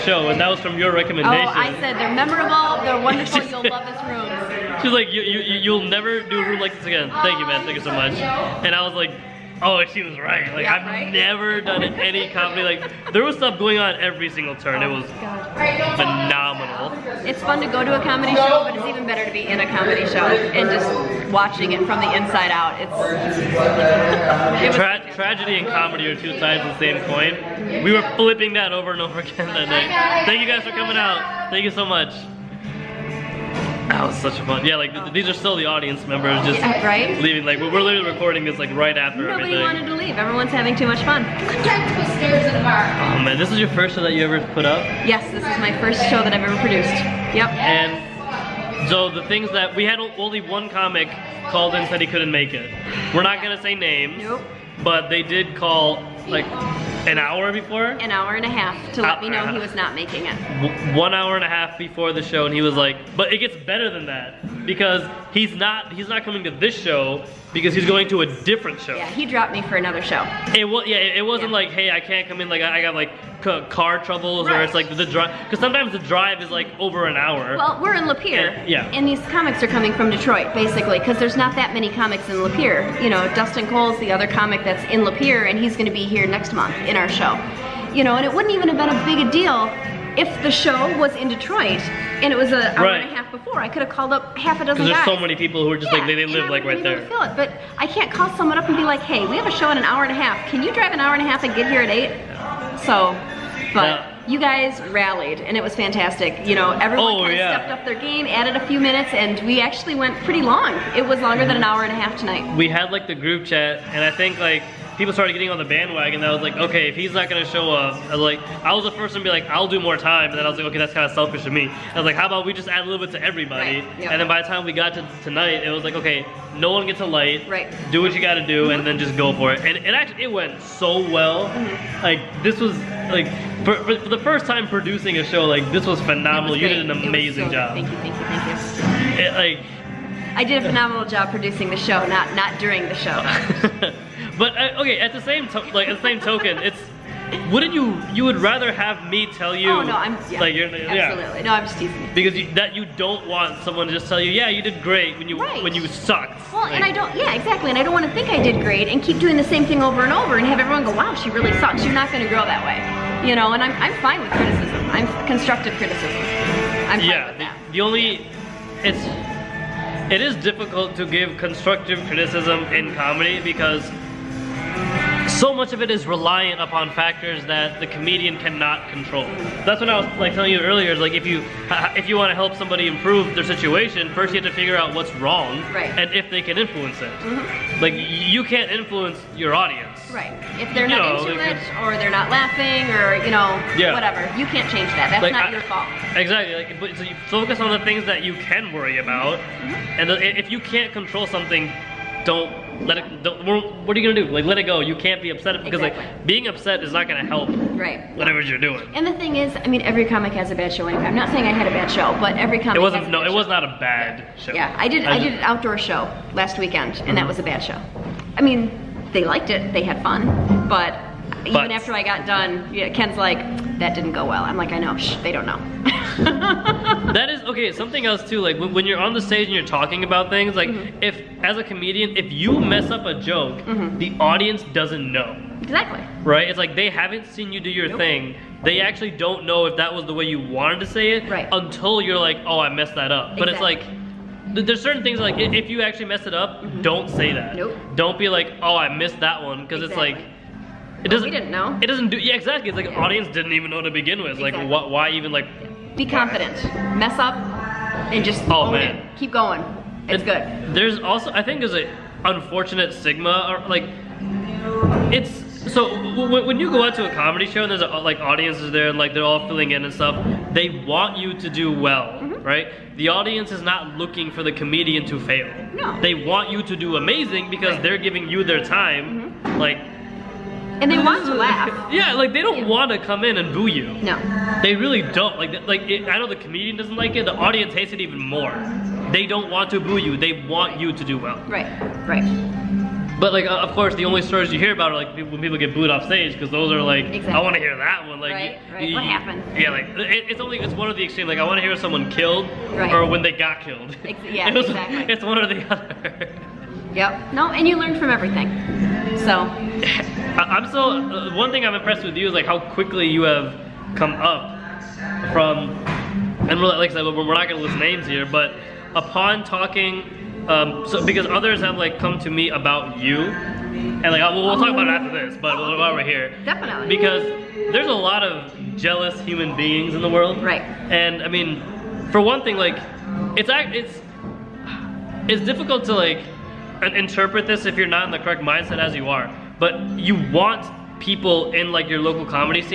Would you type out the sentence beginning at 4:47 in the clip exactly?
The audience hates it even more.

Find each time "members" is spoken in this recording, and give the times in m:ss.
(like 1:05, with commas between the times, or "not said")
0:36.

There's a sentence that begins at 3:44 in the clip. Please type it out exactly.
I'm like, I know, Shh, they don't know.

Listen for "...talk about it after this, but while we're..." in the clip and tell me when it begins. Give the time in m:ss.
5:24.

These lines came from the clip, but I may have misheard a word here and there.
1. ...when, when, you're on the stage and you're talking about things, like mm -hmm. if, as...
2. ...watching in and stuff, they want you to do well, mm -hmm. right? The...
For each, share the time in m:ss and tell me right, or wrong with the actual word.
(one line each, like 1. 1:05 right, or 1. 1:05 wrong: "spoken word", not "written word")
1. 3:48 right
2. 4:29 wrong: "filling", not "watching".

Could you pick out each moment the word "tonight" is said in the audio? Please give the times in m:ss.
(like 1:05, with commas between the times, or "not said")
1:52, 2:05.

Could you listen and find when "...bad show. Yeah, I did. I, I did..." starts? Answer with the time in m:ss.
3:33.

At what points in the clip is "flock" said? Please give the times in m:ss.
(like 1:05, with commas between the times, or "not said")
not said.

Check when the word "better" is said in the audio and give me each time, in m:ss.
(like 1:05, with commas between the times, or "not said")
0:19, 1:03.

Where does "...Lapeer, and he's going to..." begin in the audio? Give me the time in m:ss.
1:25.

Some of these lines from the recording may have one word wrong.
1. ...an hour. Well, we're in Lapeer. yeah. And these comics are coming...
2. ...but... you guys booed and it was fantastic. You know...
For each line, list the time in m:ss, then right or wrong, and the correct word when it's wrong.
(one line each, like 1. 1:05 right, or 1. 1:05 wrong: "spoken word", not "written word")
1. 1:17 right
2. 1:43 wrong: "rallied", not "booed".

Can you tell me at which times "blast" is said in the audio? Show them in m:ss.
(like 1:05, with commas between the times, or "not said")
not said.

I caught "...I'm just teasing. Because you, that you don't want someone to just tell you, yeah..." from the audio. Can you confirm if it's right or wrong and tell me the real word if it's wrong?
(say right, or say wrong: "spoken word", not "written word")
right.